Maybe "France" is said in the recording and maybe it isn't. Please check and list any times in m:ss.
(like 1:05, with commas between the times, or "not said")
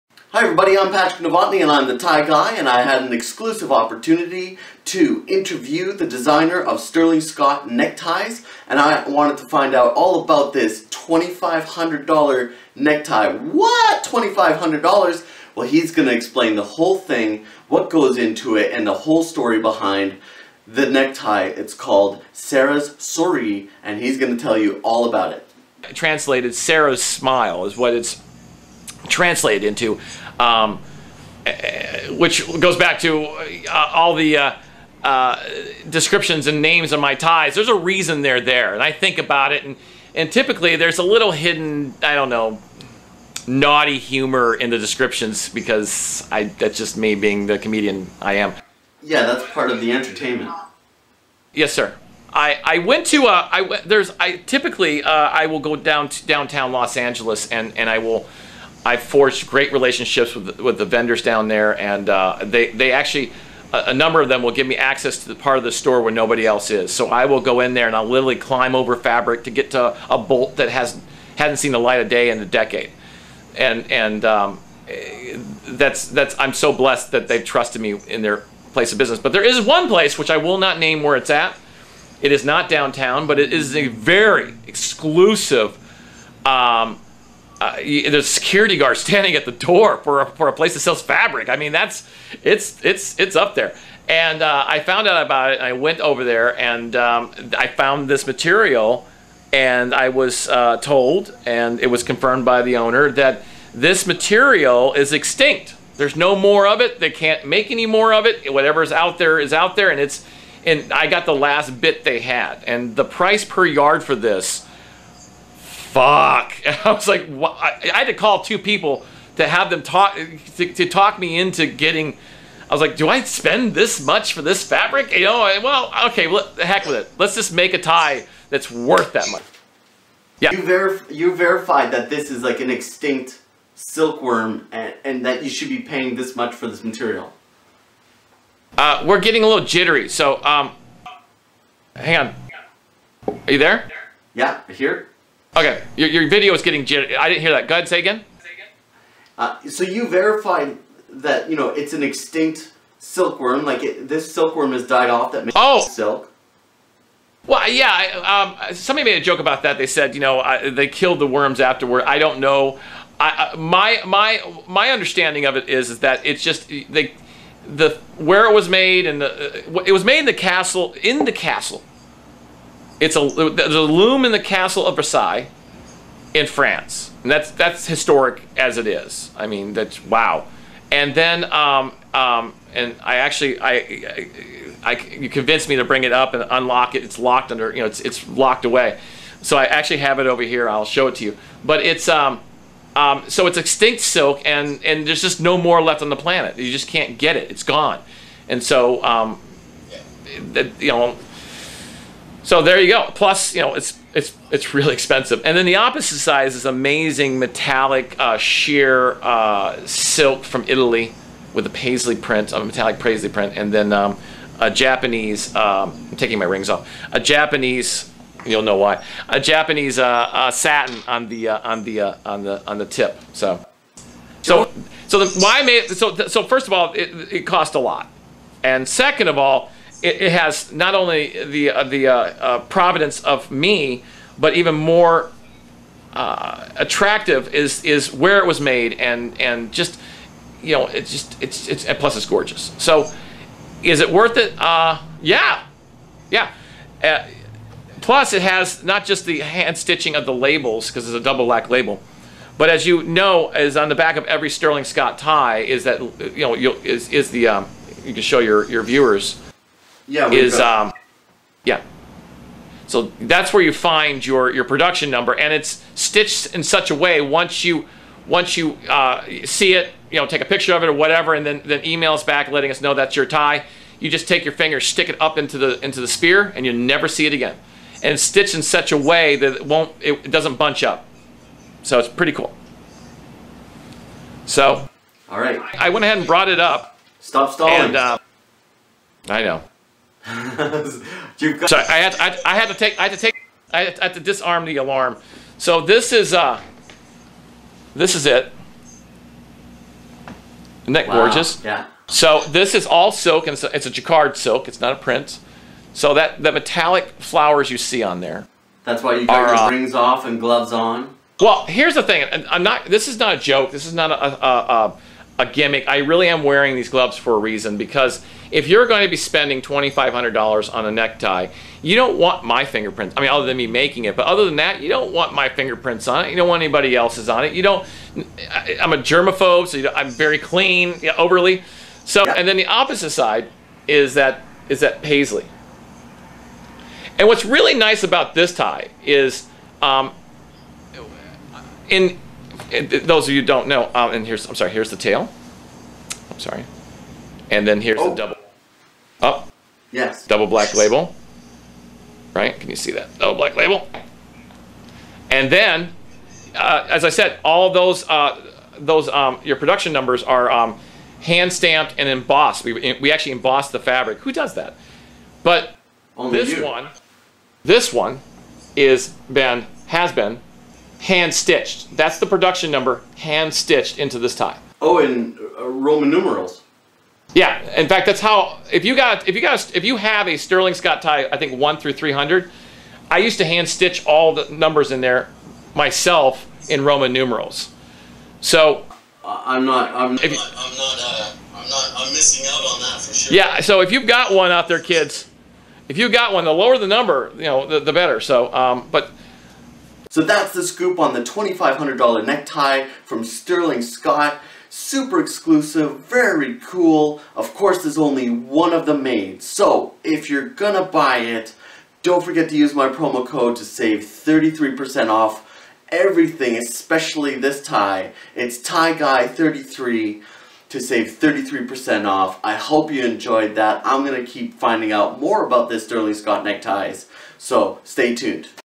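2:56.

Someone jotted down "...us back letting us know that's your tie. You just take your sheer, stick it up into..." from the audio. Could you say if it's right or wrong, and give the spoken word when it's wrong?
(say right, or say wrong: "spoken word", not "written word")
wrong: "finger", not "sheer".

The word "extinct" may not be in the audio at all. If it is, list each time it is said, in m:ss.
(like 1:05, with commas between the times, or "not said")
1:45, 2:12, 2:32, 3:13.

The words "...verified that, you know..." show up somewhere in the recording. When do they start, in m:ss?
2:30.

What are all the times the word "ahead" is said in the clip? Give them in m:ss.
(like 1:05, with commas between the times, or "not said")
2:27, 4:46.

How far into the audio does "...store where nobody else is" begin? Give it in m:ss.
1:05.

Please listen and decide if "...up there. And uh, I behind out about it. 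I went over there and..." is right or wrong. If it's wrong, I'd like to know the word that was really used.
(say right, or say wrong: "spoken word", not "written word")
wrong: "found", not "behind".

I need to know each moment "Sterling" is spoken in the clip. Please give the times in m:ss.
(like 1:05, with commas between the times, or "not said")
0:06, 4:14, 6:20, 6:43, 7:05.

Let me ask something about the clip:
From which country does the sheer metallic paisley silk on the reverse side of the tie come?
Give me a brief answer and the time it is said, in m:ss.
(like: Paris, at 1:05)
Italy, at 3:30.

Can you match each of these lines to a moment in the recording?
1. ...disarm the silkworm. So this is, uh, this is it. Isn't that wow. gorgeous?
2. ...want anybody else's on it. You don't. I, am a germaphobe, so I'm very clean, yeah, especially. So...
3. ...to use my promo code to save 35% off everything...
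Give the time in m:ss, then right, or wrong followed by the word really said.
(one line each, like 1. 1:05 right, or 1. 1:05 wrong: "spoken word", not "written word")
1. 4:54 wrong: "alarm", not "silkworm"
2. 5:26 wrong: "overly", not "especially"
3. 6:52 wrong: "33", not "35".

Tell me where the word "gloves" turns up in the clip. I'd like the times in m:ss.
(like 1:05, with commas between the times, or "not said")
5:10, 5:16.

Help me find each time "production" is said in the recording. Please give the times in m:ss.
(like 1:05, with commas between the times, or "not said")
4:24, 5:59, 6:12.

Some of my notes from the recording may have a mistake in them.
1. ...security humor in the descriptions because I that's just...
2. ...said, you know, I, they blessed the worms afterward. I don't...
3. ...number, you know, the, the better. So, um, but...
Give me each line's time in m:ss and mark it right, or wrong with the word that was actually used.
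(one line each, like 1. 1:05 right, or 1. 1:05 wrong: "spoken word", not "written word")
1. 0:43 wrong: "naughty", not "security"
2. 2:39 wrong: "killed", not "blessed"
3. 6:36 right.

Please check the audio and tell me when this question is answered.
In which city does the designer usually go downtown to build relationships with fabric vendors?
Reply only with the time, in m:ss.
0:56.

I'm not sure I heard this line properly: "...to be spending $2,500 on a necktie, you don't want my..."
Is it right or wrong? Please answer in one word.
right.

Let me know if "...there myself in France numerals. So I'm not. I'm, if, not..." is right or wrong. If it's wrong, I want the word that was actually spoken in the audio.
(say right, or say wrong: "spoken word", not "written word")
wrong: "Roman", not "France".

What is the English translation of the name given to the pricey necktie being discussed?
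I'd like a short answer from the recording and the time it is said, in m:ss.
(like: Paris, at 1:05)
Sarah's Smile, at 0:26.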